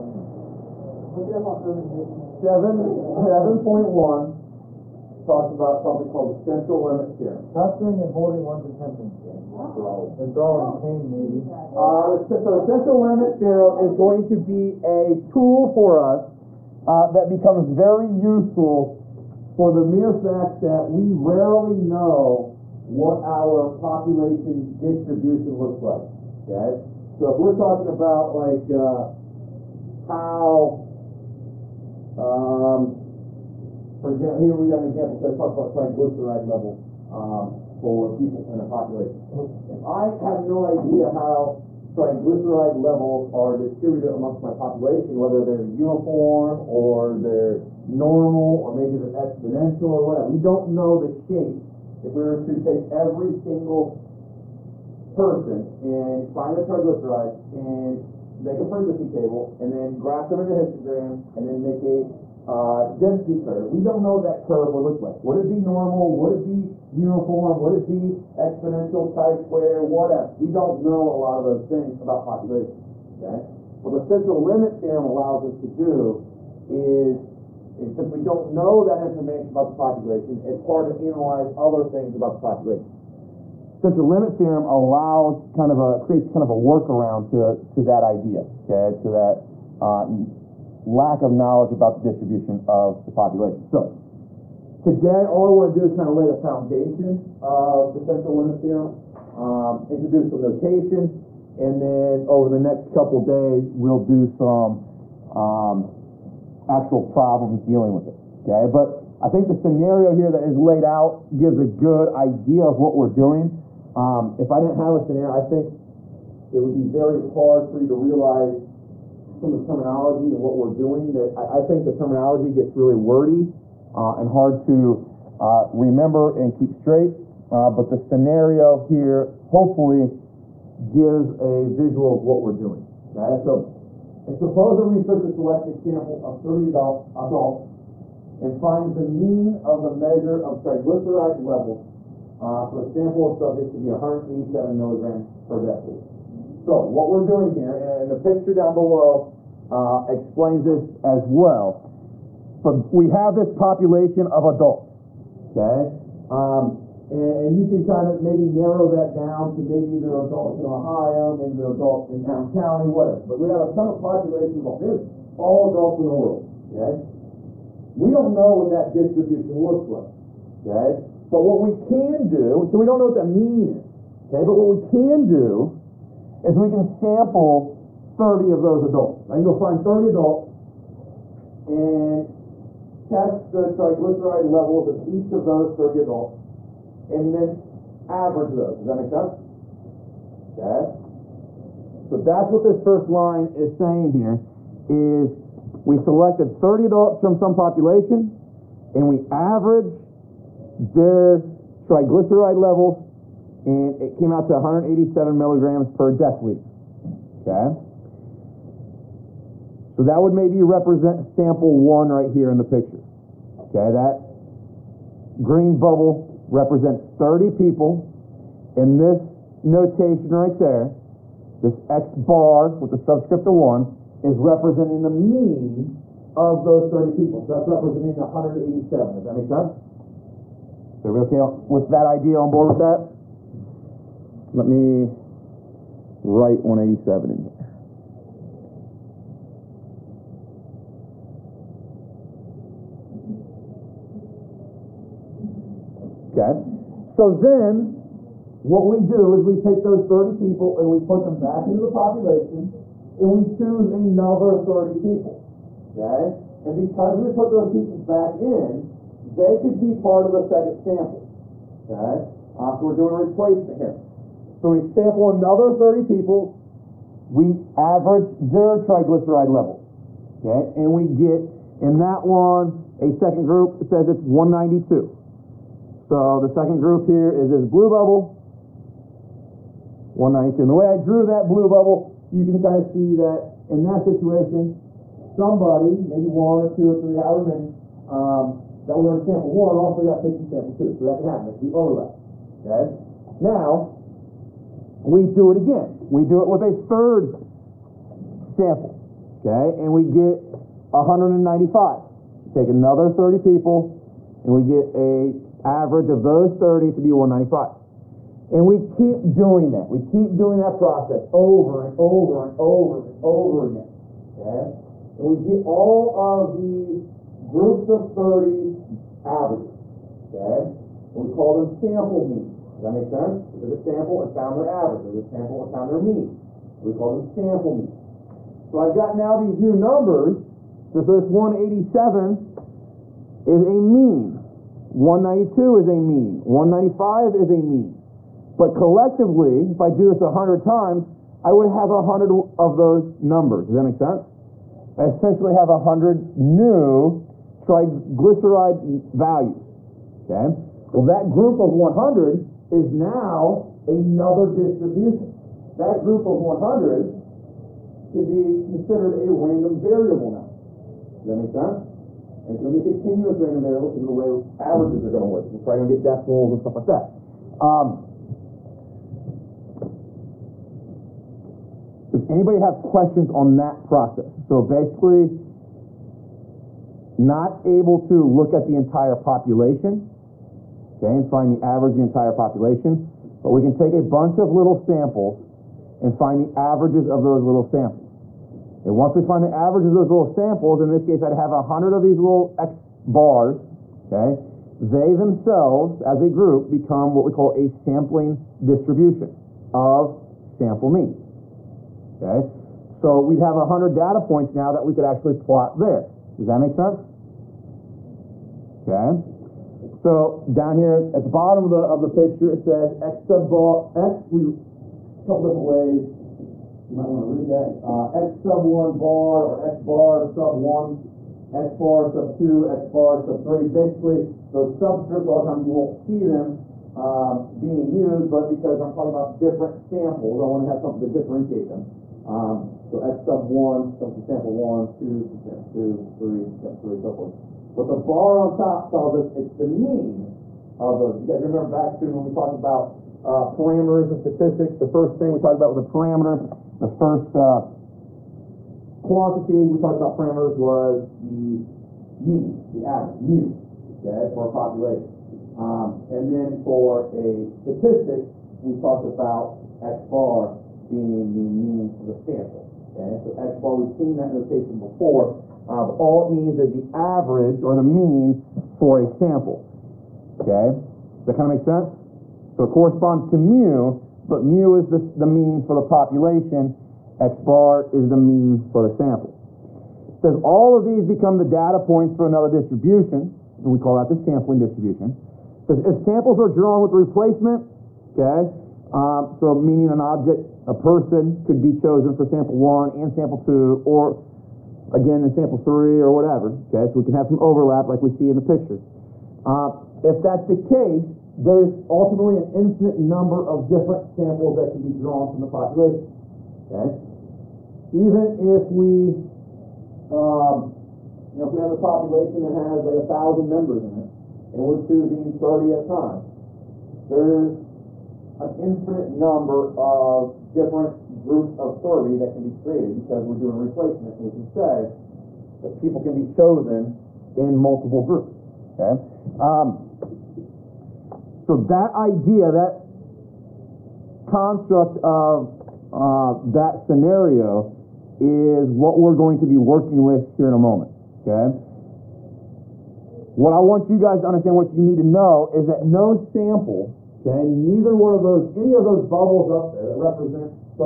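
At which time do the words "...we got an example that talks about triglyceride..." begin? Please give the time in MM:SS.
00:34.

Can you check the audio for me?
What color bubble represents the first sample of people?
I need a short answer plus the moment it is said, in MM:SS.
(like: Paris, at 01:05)
Green, at 03:35.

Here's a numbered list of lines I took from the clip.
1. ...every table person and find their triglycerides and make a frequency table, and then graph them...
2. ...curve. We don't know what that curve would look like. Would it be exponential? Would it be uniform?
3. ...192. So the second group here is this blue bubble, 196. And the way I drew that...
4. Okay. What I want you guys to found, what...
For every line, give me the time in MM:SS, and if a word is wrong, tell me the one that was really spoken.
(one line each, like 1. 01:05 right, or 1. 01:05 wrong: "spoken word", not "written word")
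1. 00:52 wrong: "single", not "table"
2. 01:03 wrong: "normal", not "exponential"
3. 04:34 wrong: "192", not "196"
4. 09:01 wrong: "understand", not "found".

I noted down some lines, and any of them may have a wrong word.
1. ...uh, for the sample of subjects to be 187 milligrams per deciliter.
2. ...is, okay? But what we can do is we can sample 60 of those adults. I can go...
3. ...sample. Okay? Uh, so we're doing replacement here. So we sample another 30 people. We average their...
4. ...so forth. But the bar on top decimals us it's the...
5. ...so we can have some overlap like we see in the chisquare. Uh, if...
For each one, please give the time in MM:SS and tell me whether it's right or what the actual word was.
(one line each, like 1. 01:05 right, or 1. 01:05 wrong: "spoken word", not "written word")
1. 02:22 right
2. 02:53 wrong: "30", not "60"
3. 04:20 right
4. 07:16 wrong: "tells", not "decimals"
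5. 08:16 wrong: "picture", not "chisquare".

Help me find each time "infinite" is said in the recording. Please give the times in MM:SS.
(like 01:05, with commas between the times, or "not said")
08:22, 08:38.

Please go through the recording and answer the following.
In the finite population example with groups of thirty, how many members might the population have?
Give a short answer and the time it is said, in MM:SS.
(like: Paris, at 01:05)
A thousand, at 08:32.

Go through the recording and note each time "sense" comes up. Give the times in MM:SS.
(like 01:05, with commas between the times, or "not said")
03:09, 03:49, 05:23, 05:43, 06:01, 06:46, 07:51.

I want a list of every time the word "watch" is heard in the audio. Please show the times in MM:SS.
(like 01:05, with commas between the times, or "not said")
not said.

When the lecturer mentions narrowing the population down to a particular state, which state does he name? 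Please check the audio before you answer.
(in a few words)
Ohio.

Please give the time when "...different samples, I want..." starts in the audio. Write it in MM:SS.
07:09.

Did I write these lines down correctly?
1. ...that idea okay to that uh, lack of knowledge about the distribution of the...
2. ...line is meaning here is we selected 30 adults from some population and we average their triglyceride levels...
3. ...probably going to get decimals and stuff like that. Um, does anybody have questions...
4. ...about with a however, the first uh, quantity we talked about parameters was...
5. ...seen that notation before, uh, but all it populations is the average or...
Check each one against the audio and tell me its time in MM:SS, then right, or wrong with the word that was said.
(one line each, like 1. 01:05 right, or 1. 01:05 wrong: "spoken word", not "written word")
1. 01:27 right
2. 03:13 wrong: "saying", not "meaning"
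3. 06:05 right
4. 07:25 wrong: "parameter", not "however"
5. 07:43 wrong: "means", not "populations".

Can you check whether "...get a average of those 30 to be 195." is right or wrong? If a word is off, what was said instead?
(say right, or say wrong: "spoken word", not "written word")
right.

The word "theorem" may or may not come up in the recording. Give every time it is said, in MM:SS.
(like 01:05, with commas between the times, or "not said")
00:07, 00:13, 01:14, 01:24, 01:38.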